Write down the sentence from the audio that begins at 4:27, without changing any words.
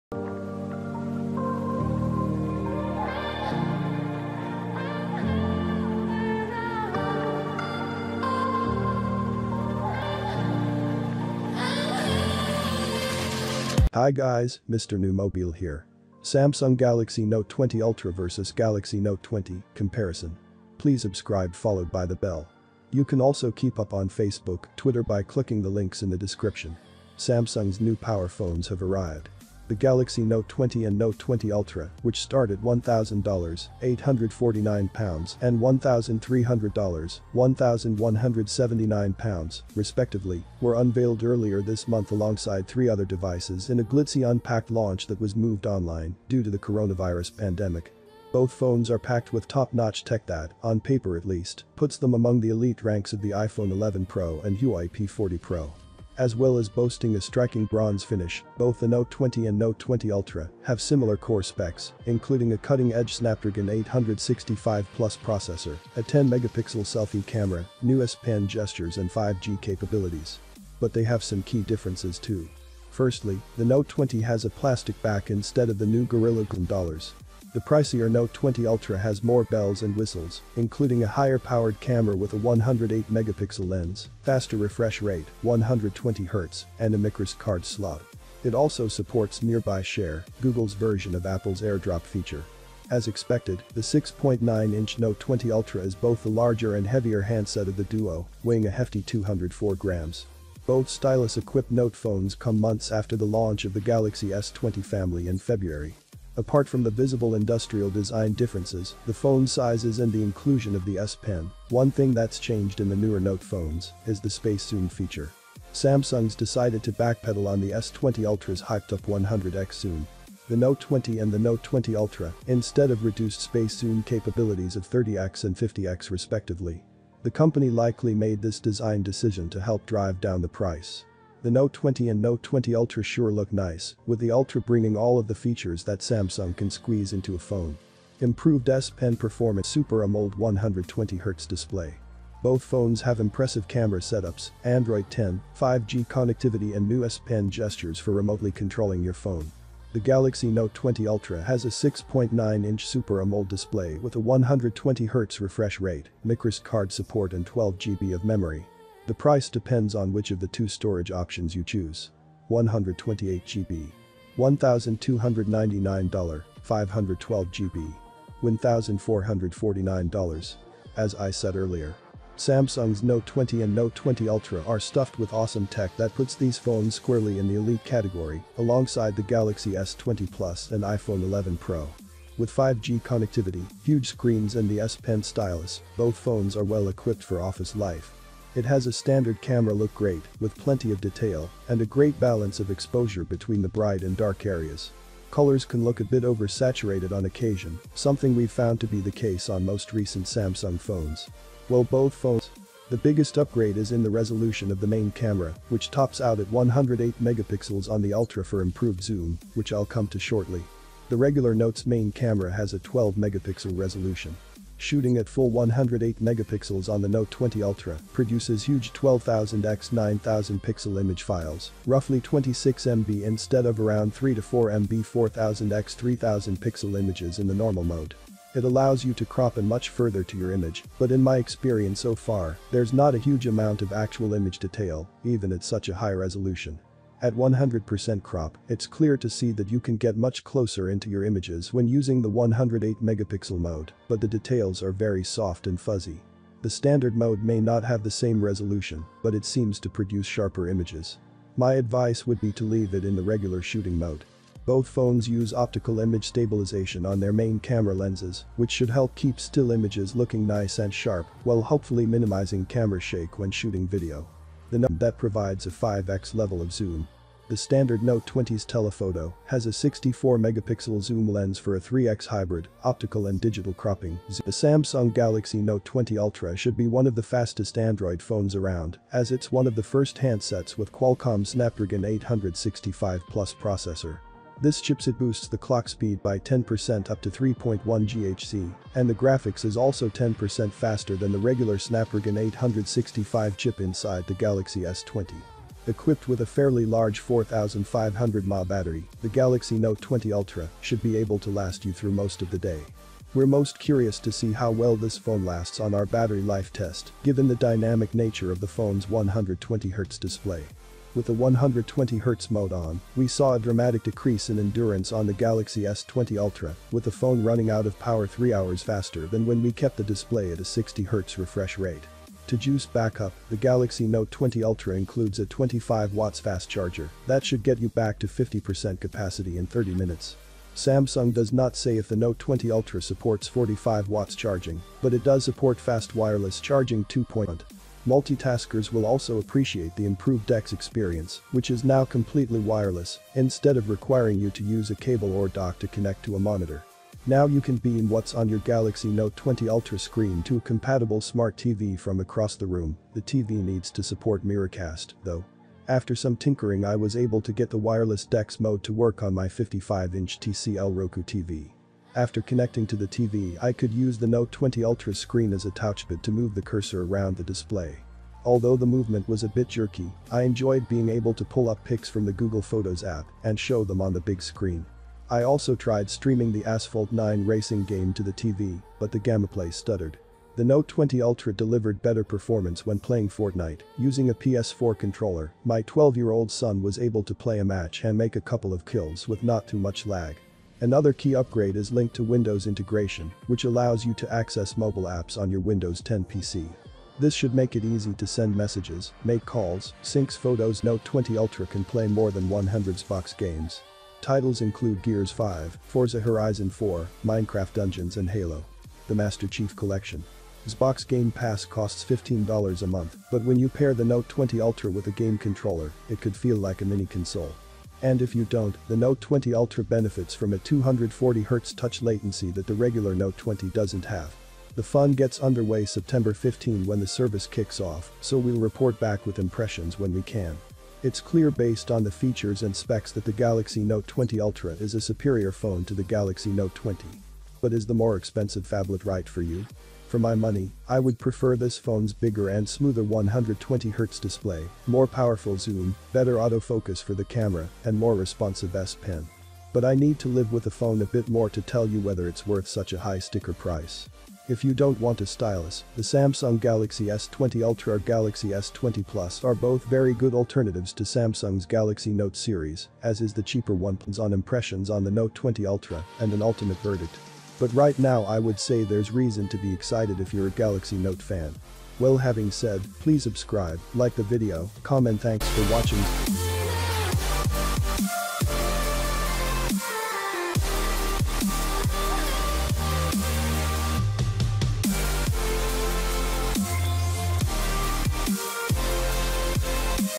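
The standard Note 20's telephoto has a 64 megapixel zoom lens for a 3x hybrid, optical and digital cropping.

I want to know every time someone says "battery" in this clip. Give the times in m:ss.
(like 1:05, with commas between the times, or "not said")
4:58, 5:06.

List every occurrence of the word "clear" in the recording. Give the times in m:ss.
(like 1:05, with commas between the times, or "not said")
3:58, 7:11.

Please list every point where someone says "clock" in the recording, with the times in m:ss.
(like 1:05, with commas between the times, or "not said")
4:45.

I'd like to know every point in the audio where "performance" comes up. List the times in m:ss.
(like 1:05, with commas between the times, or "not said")
2:19, 6:22.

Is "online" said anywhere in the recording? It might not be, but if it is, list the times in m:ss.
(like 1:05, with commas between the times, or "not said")
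0:45.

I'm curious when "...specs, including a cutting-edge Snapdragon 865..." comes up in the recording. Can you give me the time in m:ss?
1:01.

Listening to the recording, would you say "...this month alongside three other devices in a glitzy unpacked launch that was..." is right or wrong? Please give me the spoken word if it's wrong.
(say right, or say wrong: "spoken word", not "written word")
right.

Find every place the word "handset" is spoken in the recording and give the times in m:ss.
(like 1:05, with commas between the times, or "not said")
1:37, 4:40.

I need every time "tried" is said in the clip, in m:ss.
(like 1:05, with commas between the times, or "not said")
6:15.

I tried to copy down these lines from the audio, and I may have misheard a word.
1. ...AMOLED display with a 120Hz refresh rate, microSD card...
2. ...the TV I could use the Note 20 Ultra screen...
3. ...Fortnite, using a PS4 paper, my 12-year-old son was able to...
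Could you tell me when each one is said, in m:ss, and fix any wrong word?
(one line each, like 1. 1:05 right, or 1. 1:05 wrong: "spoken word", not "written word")
1. 2:33 right
2. 6:02 right
3. 6:23 wrong: "controller", not "paper".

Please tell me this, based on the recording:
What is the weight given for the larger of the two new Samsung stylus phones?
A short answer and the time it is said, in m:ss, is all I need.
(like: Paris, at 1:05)
204 grams, at 1:39.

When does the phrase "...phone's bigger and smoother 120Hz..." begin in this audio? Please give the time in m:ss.
7:21.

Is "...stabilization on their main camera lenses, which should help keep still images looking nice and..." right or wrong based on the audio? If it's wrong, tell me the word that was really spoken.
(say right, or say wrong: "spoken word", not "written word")
right.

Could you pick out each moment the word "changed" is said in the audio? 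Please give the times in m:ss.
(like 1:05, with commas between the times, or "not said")
1:52.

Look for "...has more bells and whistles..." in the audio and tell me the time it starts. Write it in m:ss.
1:18.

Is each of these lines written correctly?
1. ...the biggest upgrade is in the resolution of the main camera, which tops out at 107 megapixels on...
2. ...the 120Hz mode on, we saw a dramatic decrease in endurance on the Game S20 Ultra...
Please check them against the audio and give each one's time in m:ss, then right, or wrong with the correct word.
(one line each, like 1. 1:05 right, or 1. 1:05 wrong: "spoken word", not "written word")
1. 3:22 wrong: "108", not "107"
2. 5:11 wrong: "Galaxy", not "Game".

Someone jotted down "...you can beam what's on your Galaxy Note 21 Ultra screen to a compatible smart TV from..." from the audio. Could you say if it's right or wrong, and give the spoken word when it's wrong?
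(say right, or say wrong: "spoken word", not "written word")
wrong: "20", not "21".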